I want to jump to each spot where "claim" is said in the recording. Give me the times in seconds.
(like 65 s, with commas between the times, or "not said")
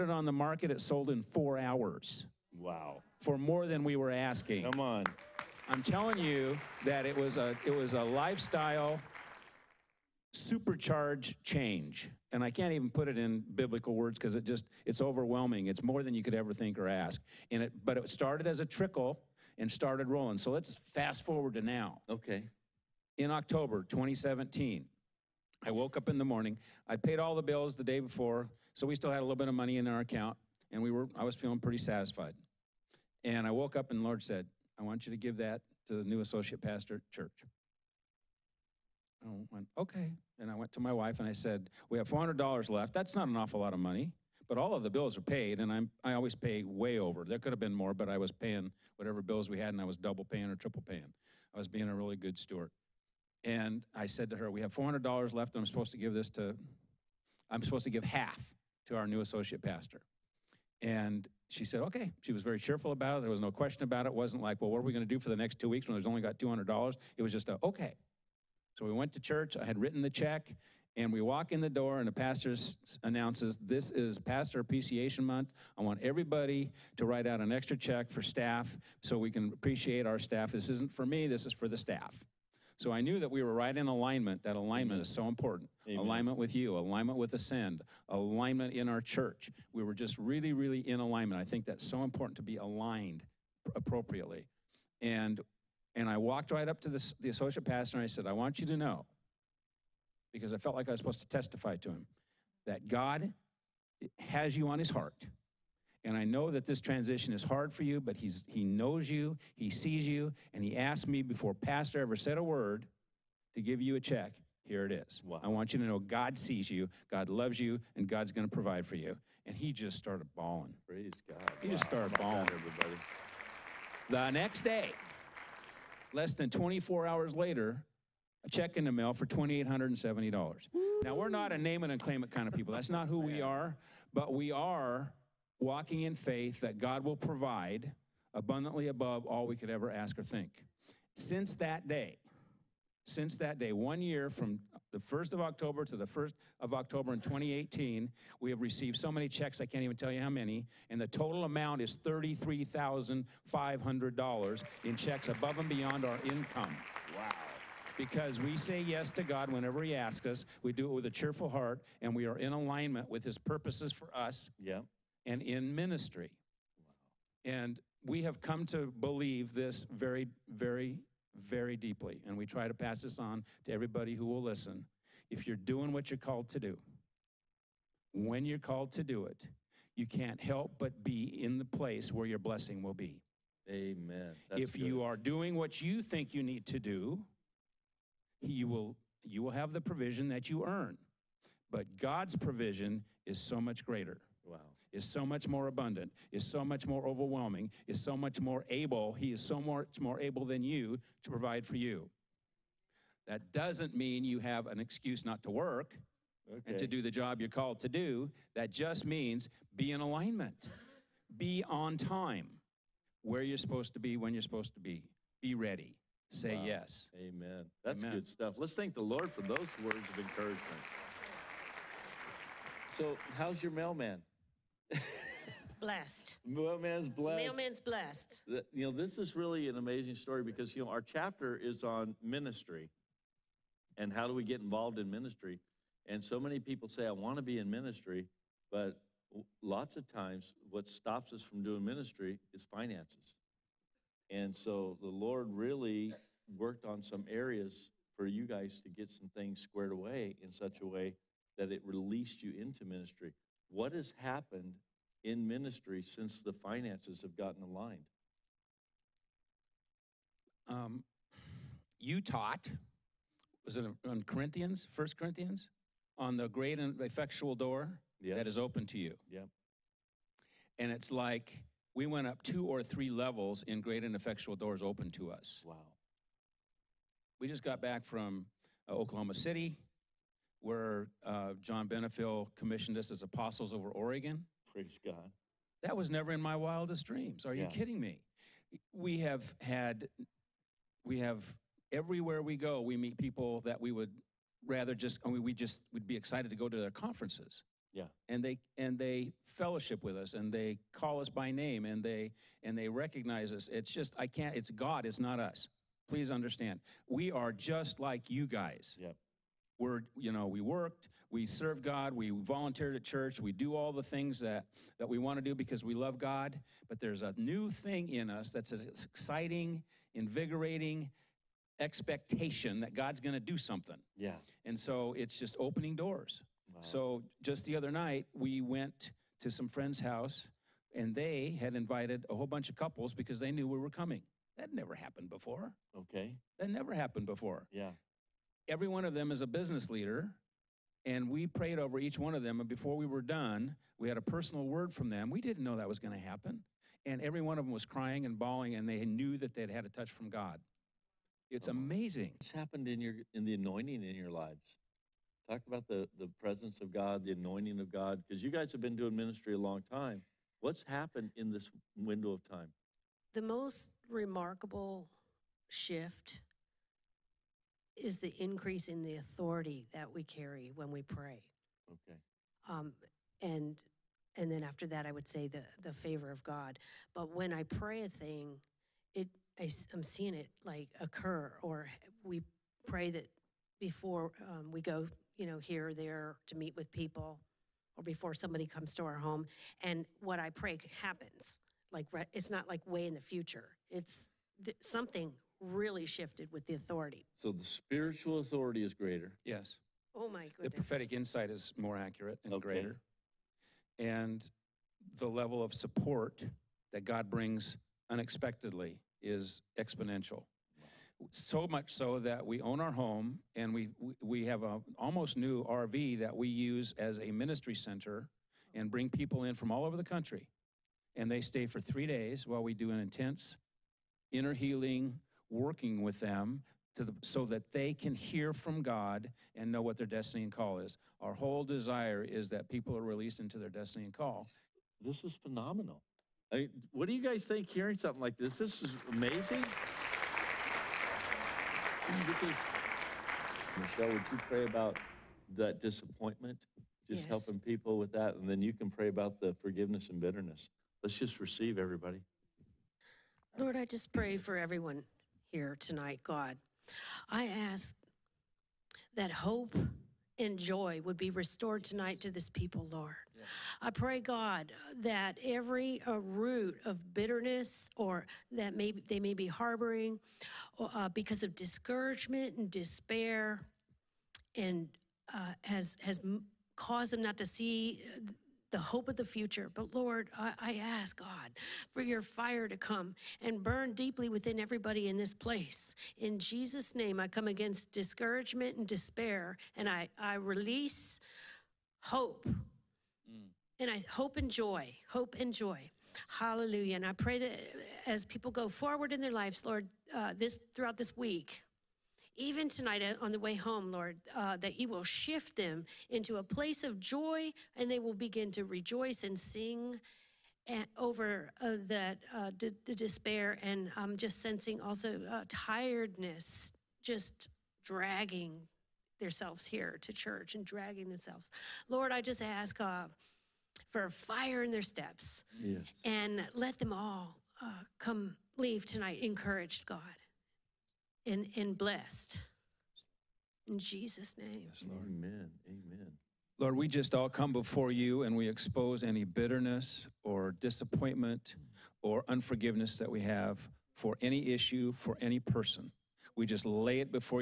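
132 s.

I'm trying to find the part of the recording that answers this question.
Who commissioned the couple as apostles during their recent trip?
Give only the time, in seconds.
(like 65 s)
281 s.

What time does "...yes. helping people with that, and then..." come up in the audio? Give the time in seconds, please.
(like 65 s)
447 s.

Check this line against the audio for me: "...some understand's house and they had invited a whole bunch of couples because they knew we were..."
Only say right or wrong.
wrong.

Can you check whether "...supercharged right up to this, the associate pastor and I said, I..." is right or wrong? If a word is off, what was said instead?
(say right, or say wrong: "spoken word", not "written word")
wrong: "walked", not "supercharged".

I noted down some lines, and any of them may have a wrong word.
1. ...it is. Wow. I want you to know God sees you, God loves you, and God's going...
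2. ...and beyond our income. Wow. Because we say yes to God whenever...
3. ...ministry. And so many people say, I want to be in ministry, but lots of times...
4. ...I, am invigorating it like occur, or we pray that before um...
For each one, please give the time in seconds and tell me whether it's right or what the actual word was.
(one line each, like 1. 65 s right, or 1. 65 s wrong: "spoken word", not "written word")
1. 114 s right
2. 155 s right
3. 235 s right
4. 379 s wrong: "seeing", not "invigorating".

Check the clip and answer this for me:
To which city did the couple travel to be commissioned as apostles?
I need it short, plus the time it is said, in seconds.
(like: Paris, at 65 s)
Oklahoma City, at 278 s.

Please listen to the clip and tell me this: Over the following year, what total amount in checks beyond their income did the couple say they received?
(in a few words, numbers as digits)
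$33,500.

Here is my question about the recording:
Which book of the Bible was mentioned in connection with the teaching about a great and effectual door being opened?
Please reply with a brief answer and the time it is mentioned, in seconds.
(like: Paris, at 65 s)
First Corinthians, at 264 s.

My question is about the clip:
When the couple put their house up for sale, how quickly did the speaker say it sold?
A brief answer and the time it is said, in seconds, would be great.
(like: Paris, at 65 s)
4 hours, at 1 s.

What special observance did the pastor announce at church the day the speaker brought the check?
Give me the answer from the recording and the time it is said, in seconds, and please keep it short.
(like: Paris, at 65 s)
Pastor Appreciation Month, at 74 s.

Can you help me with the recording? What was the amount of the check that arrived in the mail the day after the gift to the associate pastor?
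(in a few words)
$2,870.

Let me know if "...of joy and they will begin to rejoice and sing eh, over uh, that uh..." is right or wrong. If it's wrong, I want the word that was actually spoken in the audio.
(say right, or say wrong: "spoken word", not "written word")
right.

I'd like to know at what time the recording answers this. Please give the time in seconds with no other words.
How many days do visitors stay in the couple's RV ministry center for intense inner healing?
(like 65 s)
421 s.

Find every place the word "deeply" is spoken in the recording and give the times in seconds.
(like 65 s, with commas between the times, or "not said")
171 s, 483 s.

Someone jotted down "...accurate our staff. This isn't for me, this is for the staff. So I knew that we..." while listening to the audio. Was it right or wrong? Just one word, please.
wrong.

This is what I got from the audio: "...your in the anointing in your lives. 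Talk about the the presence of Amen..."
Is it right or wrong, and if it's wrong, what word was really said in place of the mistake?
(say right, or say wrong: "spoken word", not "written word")
wrong: "God", not "Amen".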